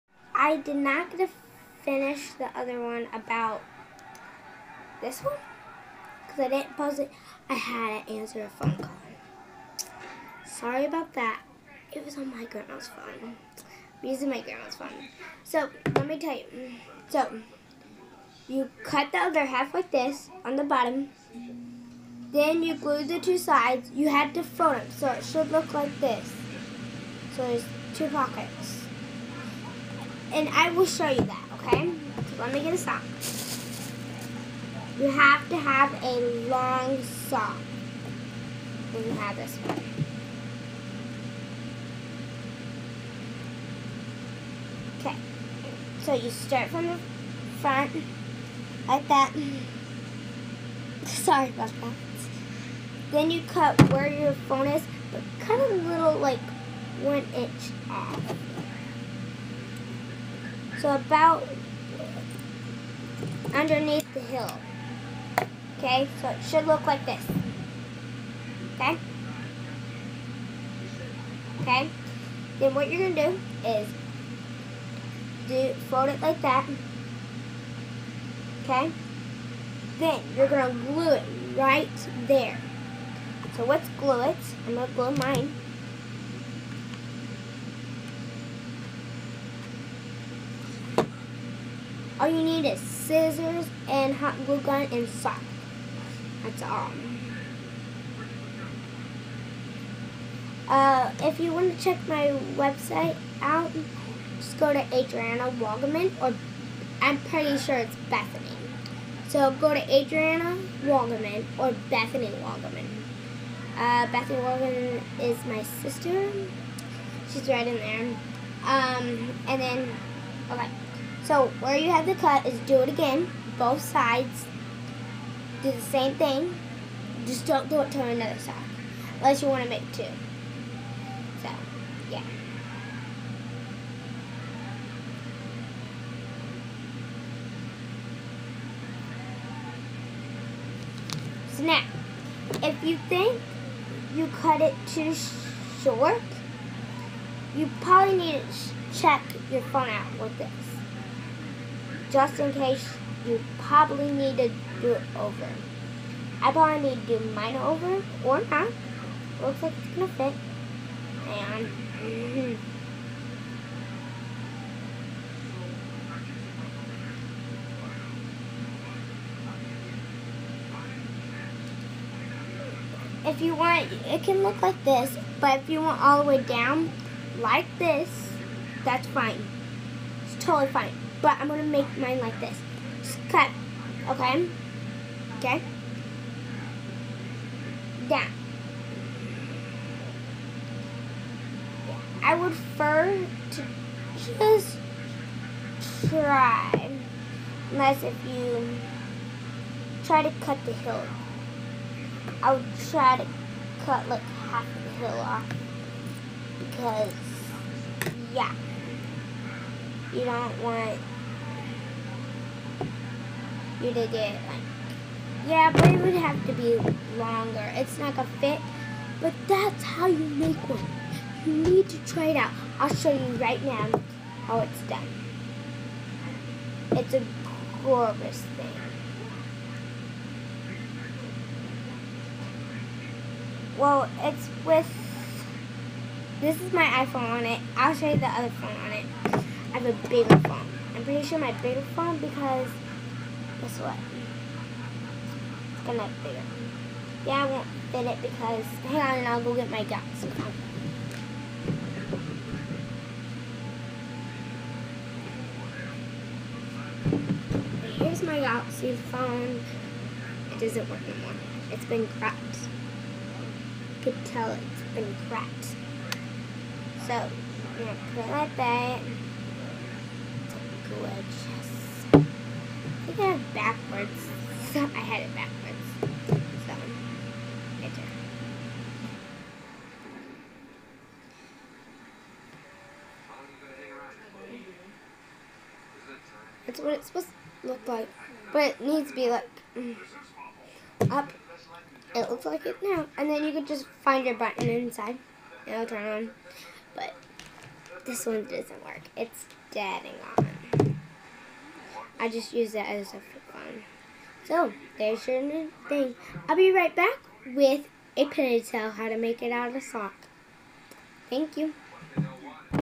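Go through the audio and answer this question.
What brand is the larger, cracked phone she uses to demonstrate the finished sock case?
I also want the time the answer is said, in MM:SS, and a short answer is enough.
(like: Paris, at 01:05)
Galaxy, at 04:18.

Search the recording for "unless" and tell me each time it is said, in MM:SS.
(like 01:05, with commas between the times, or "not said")
02:09, 03:17.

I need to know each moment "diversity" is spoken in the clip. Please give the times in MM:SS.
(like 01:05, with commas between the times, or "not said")
not said.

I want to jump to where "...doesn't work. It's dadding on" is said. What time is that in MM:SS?
04:58.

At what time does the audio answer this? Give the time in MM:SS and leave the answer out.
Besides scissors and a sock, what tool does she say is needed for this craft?
01:34.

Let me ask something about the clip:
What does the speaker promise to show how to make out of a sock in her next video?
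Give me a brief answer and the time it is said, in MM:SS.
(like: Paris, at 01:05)
A ponytail, at 05:08.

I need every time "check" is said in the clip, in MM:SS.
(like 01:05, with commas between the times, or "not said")
01:41, 02:28.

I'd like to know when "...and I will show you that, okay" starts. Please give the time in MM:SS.
00:30.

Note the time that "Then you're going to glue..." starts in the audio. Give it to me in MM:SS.
01:19.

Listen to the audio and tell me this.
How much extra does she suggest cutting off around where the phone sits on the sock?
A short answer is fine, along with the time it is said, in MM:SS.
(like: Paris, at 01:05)
1 inch, at 00:57.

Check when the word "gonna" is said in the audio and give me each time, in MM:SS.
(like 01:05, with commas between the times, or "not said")
02:39, 03:01, 03:38, 04:05, 04:27.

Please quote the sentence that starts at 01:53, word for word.
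Uh, Bethany Walgaman is my sister.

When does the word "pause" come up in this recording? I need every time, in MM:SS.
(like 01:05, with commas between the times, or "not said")
00:06.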